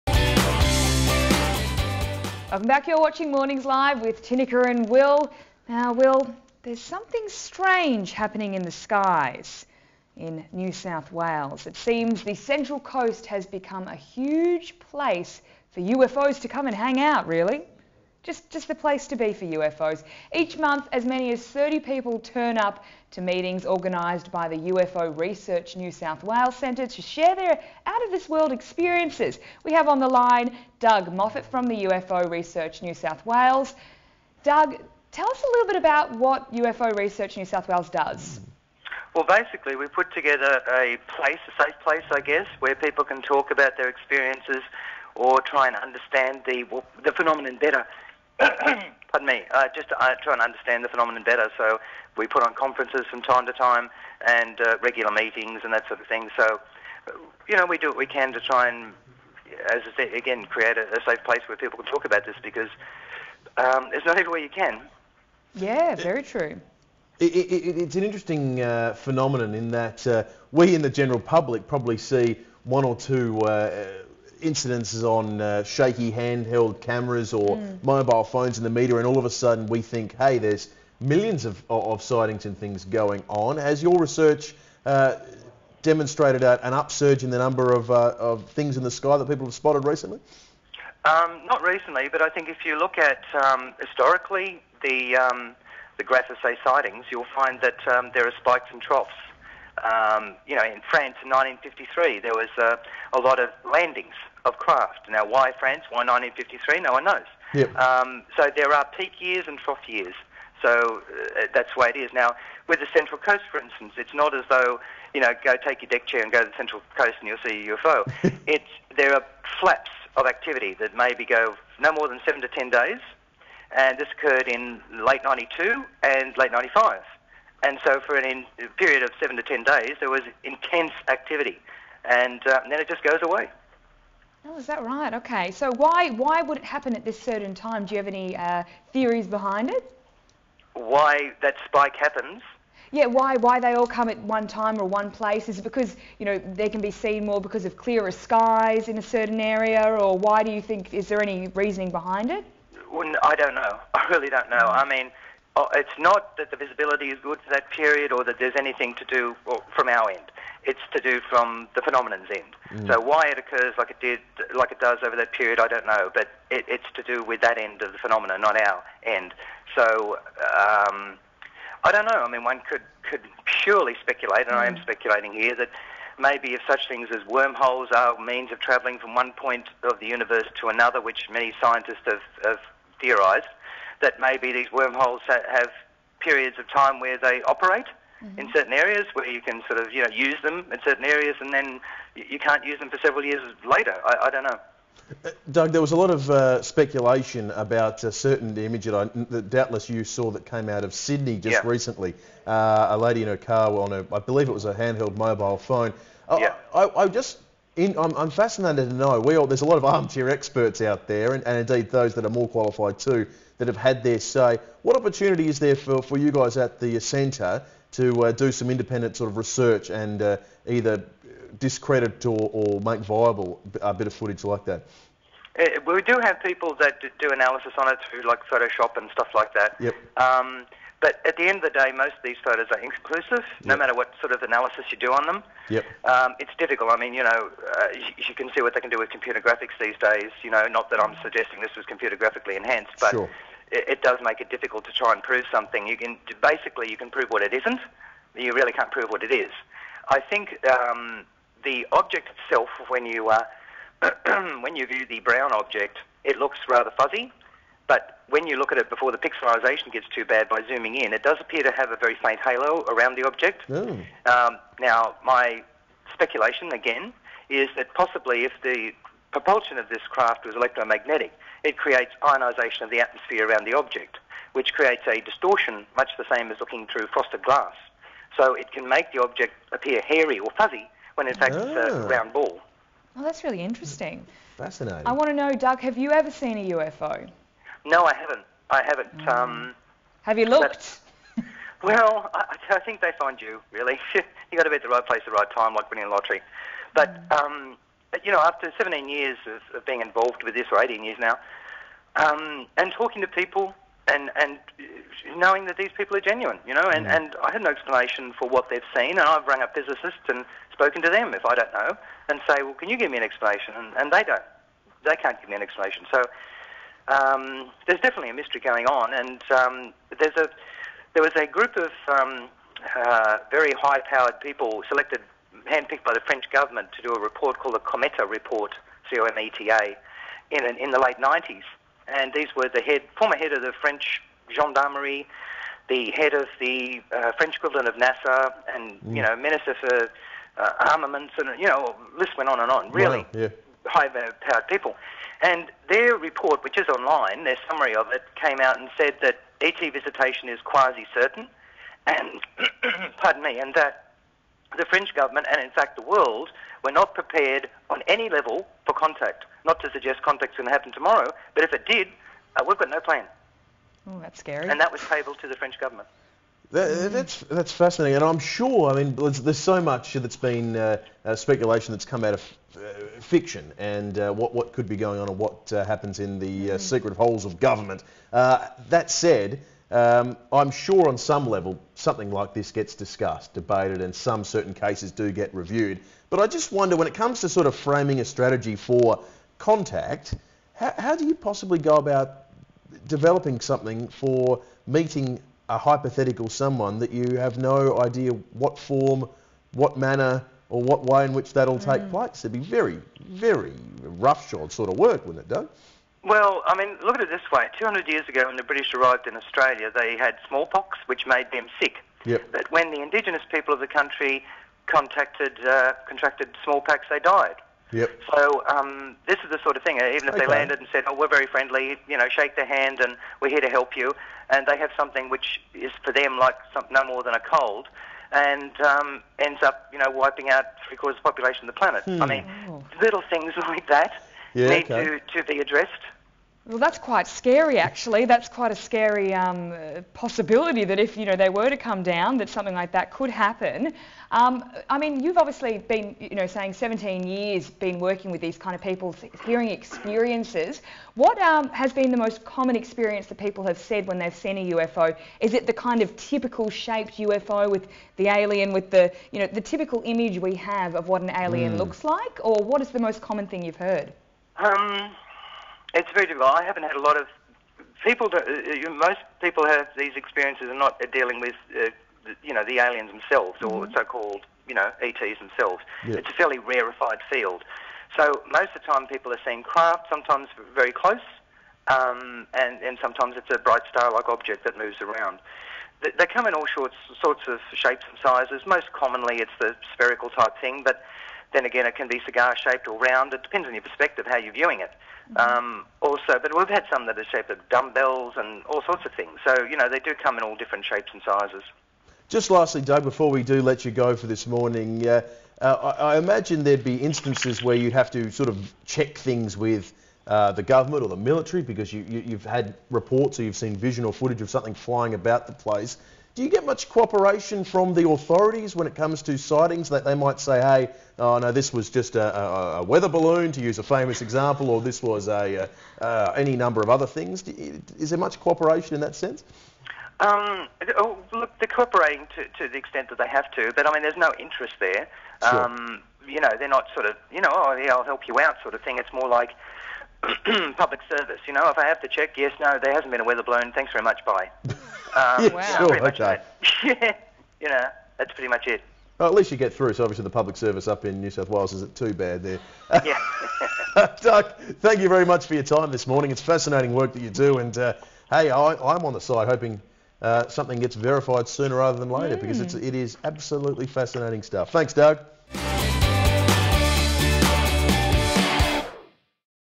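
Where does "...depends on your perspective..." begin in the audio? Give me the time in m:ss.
8:13.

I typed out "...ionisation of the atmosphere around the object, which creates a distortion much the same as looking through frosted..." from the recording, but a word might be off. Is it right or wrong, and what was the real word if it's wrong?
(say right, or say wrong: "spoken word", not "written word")
right.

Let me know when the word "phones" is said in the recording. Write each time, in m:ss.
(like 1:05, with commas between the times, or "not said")
1:18, 3:25.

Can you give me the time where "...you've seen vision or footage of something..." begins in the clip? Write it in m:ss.
8:33.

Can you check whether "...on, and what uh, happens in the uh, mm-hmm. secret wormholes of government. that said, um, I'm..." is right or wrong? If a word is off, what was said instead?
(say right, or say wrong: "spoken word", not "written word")
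wrong: "holes", not "wormholes".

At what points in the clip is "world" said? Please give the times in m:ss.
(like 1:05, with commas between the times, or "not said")
0:28, 5:56.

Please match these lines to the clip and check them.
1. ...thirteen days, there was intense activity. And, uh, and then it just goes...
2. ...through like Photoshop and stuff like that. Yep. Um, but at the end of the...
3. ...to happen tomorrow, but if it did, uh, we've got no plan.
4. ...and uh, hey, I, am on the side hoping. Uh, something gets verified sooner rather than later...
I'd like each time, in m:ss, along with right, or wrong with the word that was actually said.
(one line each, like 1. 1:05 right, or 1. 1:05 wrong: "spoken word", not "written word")
1. 2:09 wrong: "ten", not "thirteen"
2. 3:48 right
3. 6:00 right
4. 9:17 right.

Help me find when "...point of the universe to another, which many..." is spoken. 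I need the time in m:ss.
2:59.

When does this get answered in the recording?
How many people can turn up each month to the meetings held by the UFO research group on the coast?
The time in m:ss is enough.
0:21.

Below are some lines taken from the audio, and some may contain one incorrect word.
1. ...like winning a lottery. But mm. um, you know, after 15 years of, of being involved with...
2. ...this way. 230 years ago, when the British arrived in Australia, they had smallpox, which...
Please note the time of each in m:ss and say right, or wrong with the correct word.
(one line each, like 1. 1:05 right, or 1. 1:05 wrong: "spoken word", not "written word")
1. 4:55 wrong: "17", not "15"
2. 6:47 wrong: "200", not "230".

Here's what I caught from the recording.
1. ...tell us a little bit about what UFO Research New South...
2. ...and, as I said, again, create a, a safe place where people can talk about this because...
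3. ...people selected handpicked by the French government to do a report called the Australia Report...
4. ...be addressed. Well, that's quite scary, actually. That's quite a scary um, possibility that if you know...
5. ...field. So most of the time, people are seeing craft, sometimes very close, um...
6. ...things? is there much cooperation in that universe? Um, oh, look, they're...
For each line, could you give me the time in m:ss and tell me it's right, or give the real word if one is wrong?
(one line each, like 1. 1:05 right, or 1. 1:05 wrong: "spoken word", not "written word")
1. 0:35 right
2. 0:58 right
3. 5:24 wrong: "Cometa", not "Australia"
4. 7:15 right
5. 7:57 right
6. 8:47 wrong: "sense", not "universe".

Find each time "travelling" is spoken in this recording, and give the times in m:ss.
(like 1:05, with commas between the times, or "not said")
2:58.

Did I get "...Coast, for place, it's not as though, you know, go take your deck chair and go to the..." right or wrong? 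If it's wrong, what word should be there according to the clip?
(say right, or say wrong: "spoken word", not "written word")
wrong: "instance", not "place".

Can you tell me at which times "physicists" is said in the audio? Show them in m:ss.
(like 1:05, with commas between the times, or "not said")
5:09.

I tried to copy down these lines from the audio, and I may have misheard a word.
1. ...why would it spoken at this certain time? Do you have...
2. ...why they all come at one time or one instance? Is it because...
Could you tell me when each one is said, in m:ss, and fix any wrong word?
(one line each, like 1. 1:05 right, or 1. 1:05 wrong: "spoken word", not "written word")
1. 2:16 wrong: "happen", not "spoken"
2. 2:23 wrong: "place", not "instance".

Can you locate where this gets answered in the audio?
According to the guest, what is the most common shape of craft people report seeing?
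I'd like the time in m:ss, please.
8:09.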